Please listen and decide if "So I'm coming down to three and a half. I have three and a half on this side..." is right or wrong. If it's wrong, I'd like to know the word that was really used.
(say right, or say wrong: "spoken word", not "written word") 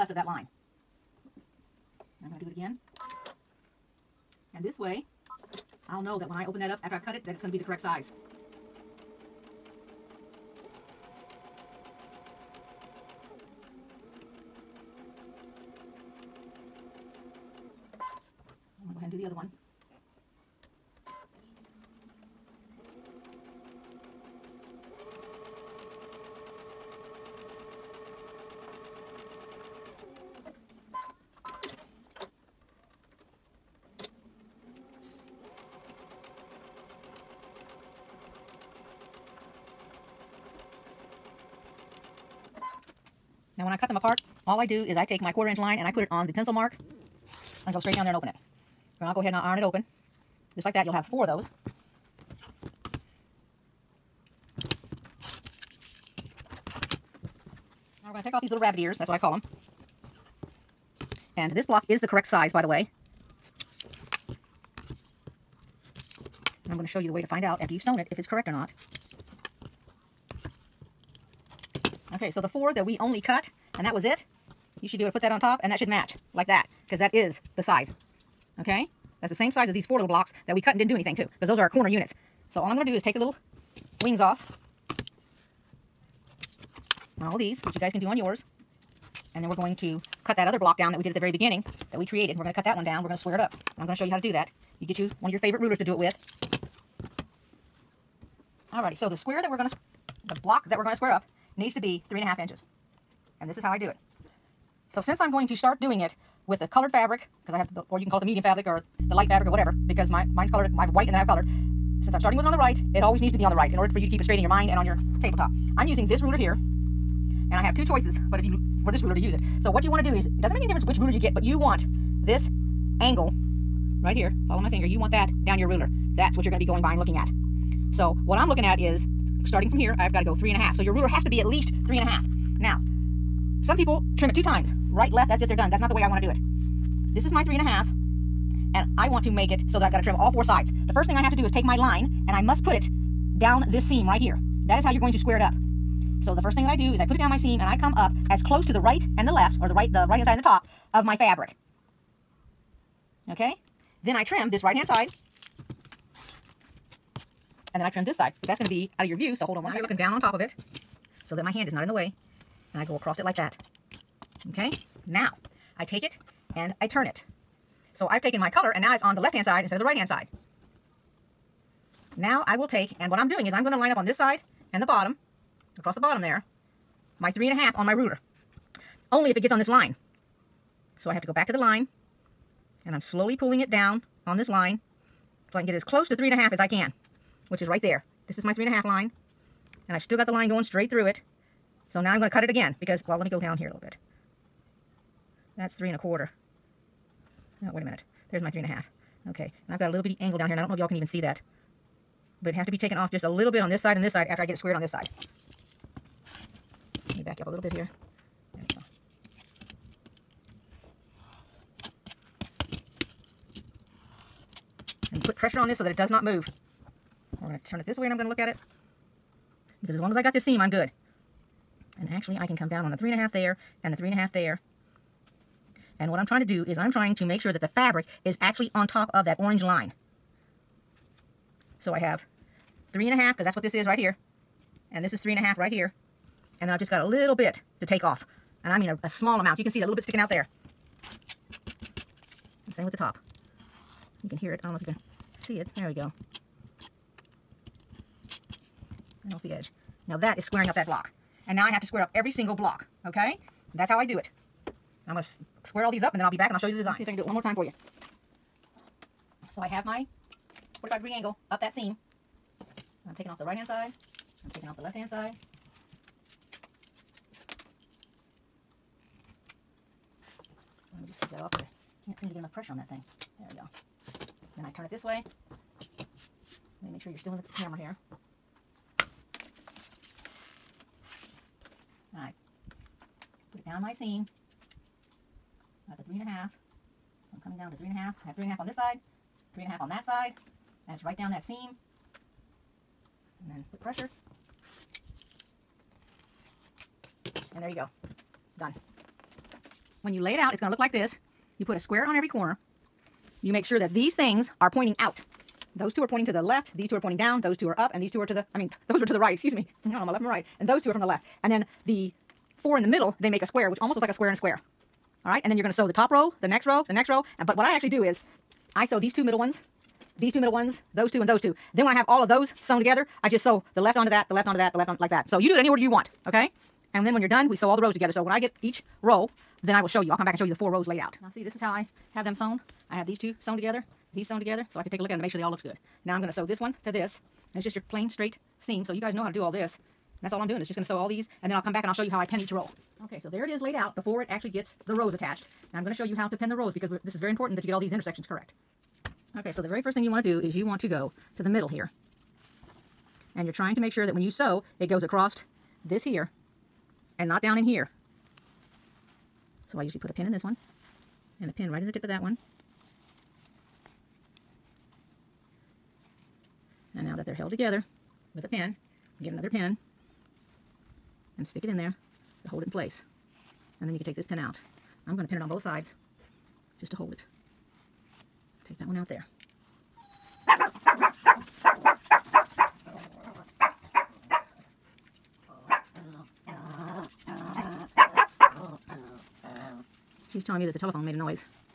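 right.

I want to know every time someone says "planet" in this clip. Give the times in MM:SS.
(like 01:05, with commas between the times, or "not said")
not said.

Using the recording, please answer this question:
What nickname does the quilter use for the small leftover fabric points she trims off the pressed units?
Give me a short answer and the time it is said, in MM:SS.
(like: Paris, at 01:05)
rabbit ears, at 00:58.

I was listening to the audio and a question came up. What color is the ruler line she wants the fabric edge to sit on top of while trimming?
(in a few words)
orange.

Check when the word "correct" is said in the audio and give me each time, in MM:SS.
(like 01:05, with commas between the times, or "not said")
00:07, 01:02, 01:08, 05:48.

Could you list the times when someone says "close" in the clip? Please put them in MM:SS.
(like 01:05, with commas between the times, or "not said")
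02:28, 03:05.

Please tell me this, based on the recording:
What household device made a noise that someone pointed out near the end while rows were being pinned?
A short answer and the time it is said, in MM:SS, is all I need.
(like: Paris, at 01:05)
telephone, at 06:30.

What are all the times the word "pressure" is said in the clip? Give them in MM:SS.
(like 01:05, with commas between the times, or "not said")
03:35, 04:32, 04:53.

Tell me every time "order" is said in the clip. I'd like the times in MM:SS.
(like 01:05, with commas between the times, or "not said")
01:53, 05:25.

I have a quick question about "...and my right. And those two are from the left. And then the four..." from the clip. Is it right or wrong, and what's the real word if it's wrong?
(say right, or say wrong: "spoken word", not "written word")
right.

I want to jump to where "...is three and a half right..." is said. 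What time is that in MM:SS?
03:55.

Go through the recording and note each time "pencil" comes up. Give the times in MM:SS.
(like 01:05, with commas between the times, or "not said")
00:46.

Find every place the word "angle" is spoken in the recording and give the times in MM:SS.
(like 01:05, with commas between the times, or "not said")
02:03, 03:20, 04:21.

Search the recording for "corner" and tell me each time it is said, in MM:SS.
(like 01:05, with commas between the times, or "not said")
01:21, 05:02.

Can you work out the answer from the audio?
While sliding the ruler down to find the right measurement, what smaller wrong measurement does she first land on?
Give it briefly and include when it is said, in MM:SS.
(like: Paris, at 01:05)
three and a quarter, at 03:15.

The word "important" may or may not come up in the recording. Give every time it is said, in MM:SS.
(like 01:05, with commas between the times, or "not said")
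05:47.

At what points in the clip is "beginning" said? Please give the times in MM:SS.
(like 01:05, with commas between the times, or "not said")
01:31.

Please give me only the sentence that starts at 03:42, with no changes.
And actually, I can come down on the three and a half there and the three and a half there.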